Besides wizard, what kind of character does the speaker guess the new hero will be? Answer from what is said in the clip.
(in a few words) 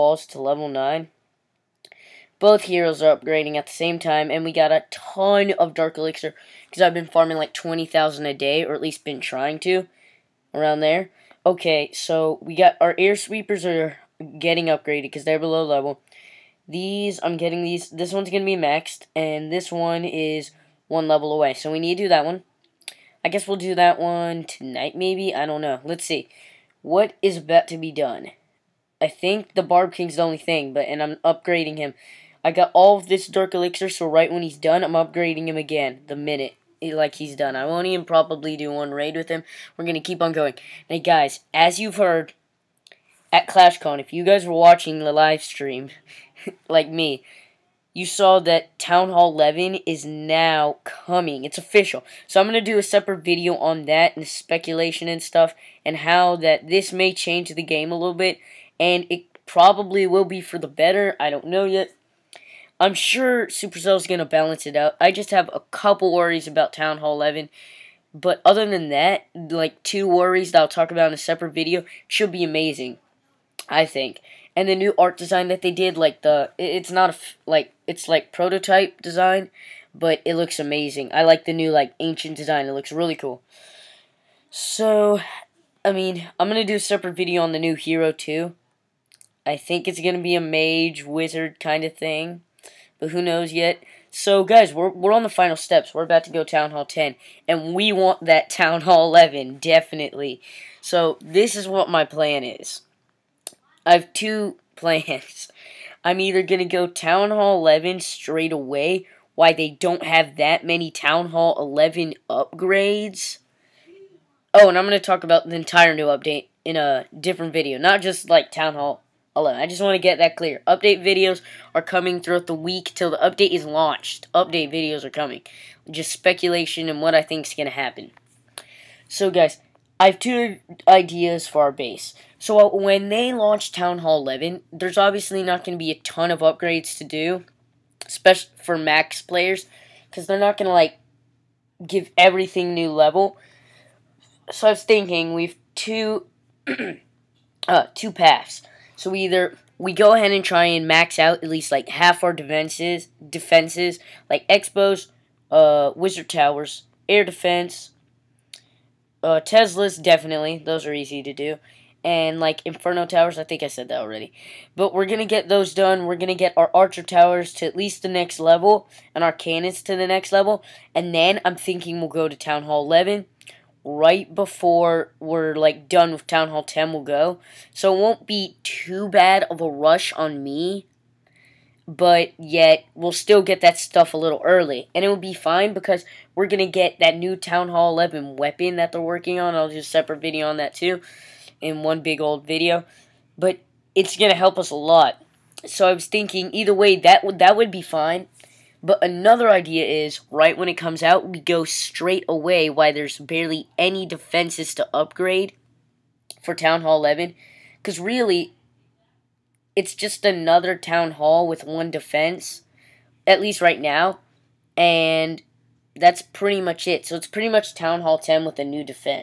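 A mage.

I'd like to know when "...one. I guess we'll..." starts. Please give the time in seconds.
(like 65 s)
22 s.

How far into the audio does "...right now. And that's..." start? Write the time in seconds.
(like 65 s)
213 s.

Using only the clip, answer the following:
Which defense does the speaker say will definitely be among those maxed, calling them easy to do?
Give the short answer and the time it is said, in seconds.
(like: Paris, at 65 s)
Teslas, at 159 s.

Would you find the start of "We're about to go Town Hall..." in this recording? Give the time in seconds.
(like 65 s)
95 s.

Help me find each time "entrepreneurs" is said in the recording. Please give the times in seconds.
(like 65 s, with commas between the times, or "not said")
not said.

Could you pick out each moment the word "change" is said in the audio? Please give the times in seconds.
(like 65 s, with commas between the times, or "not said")
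57 s.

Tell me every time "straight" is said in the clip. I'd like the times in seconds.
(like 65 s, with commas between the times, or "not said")
108 s, 201 s.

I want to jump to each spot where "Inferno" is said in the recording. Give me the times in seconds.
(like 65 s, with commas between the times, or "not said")
162 s.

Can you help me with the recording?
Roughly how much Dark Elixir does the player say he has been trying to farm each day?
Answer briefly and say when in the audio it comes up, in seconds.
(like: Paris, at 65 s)
20,000, at 7 s.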